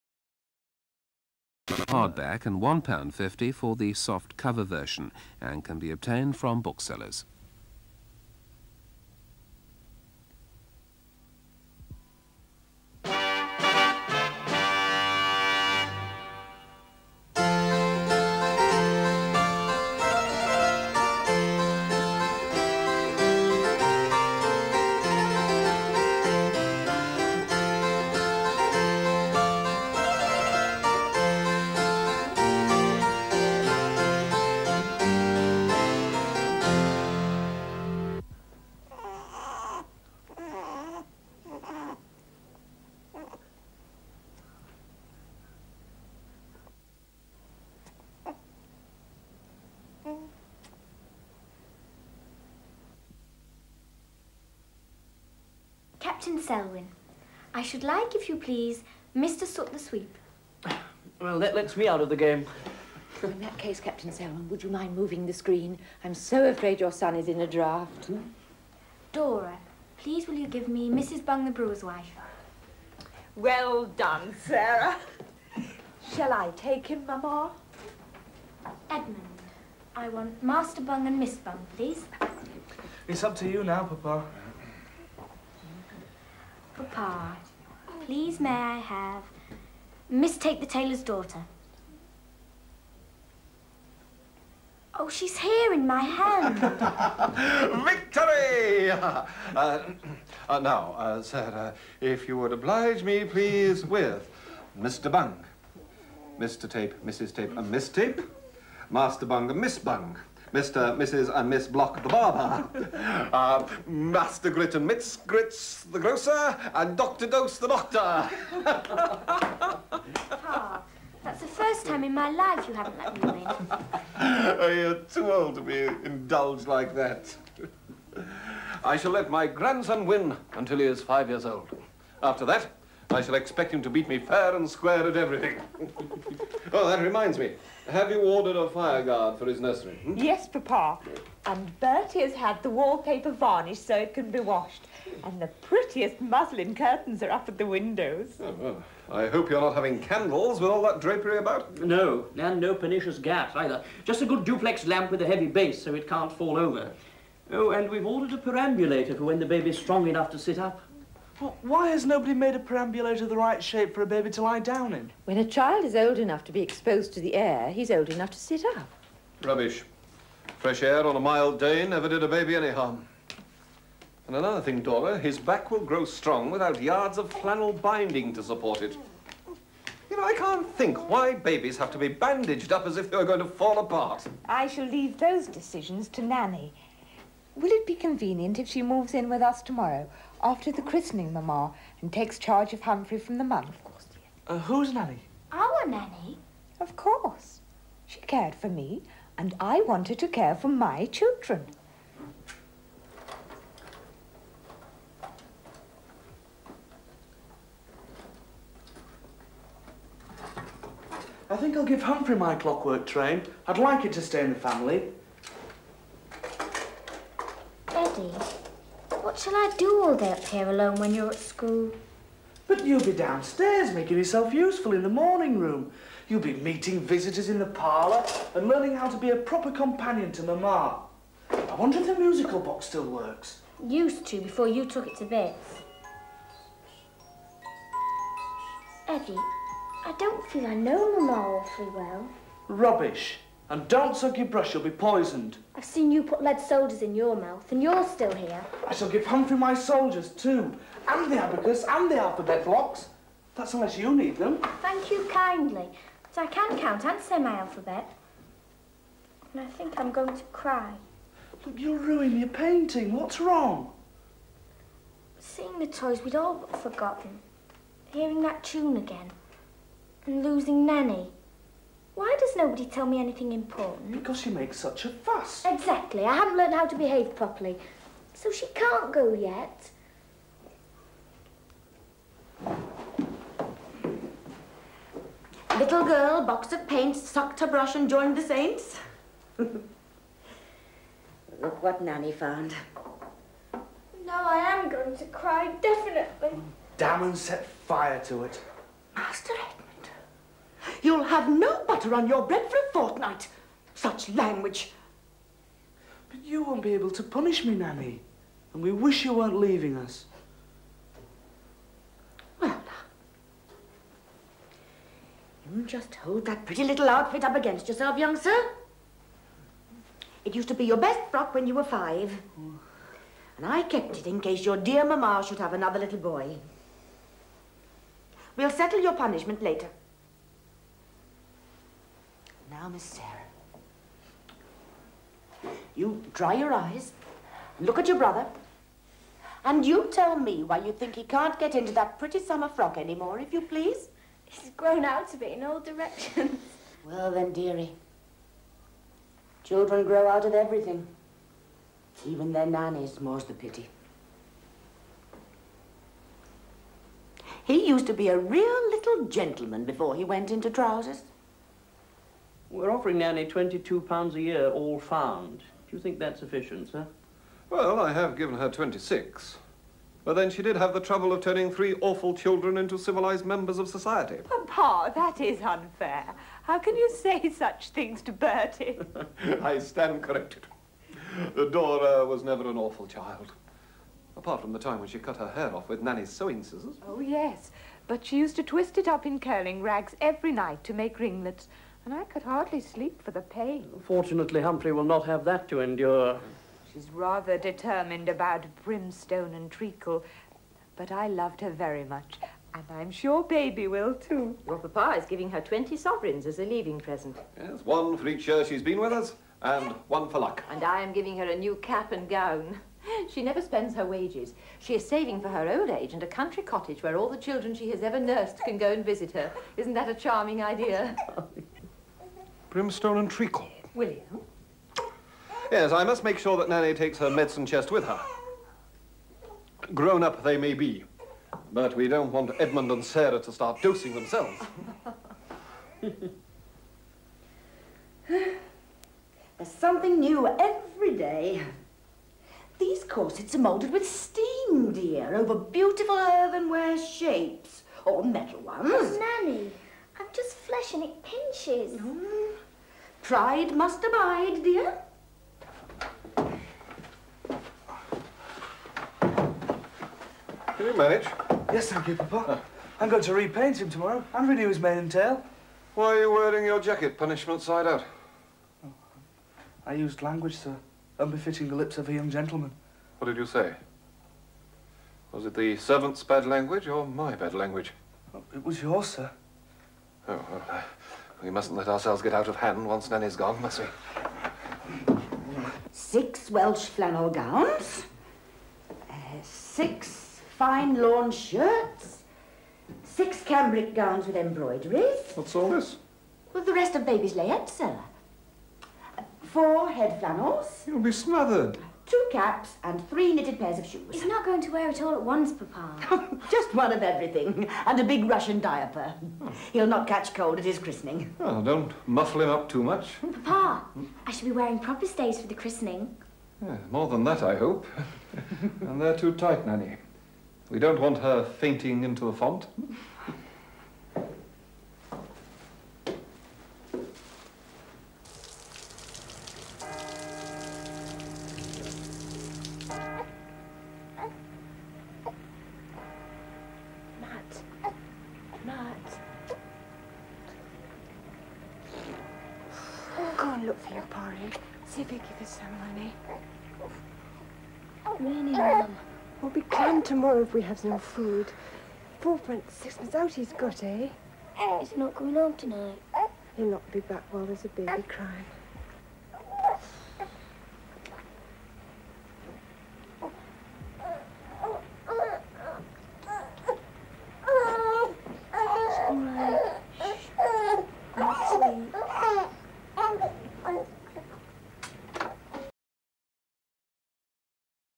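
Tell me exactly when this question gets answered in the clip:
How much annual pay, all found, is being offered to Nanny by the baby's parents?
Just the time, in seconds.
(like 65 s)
363 s.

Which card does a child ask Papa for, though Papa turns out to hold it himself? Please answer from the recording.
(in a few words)
Miss Tape the Tailor's Daughter.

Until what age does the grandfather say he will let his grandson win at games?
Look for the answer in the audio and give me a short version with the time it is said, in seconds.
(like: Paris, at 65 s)
5, at 131 s.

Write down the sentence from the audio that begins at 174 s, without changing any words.
And another thing, Dora, his back will grow strong without yards of flannel binding to support it.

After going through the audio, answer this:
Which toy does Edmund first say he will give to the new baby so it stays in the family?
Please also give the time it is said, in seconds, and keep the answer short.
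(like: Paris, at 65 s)
clockwork train, at 212 s.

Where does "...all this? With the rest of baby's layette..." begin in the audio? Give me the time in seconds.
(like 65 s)
495 s.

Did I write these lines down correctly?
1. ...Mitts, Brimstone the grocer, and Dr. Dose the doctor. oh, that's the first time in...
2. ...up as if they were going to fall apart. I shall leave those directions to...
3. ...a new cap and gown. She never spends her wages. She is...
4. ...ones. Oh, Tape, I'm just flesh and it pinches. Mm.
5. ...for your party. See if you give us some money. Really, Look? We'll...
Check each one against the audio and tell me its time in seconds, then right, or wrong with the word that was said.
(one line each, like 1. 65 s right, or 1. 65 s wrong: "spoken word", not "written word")
1. 114 s wrong: "Grits", not "Brimstone"
2. 182 s wrong: "decisions", not "directions"
3. 411 s right
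4. 448 s wrong: "Nanny", not "Tape"
5. 543 s wrong: "Mum", not "Look".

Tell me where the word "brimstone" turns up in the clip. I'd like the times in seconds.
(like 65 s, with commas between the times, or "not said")
398 s, 422 s.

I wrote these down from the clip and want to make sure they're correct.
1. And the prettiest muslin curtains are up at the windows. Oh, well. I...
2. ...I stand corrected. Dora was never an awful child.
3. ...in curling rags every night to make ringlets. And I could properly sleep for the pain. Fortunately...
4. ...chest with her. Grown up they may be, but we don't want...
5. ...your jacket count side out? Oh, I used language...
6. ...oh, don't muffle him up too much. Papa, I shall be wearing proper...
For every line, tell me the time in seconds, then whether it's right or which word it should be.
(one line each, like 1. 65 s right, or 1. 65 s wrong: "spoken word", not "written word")
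1. 145 s right
2. 379 s right
3. 389 s wrong: "hardly", not "properly"
4. 427 s right
5. 466 s wrong: "punishment", not "count"
6. 511 s right.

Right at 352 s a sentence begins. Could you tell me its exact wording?
Even their nannies, more's the pity.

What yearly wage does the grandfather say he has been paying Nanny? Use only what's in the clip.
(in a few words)
26.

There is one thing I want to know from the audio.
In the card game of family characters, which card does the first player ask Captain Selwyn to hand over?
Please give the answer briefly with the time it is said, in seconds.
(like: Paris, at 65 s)
Mr. Soot the Sweep, at 59 s.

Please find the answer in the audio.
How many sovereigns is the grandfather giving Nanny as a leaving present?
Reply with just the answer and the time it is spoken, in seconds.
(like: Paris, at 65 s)
20, at 405 s.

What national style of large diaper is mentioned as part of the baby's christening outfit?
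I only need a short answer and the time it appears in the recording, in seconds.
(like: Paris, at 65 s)
Russian, at 508 s.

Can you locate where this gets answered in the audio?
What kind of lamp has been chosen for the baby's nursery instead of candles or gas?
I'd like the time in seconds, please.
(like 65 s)
154 s.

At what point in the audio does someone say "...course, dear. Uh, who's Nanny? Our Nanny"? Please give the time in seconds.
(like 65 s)
193 s.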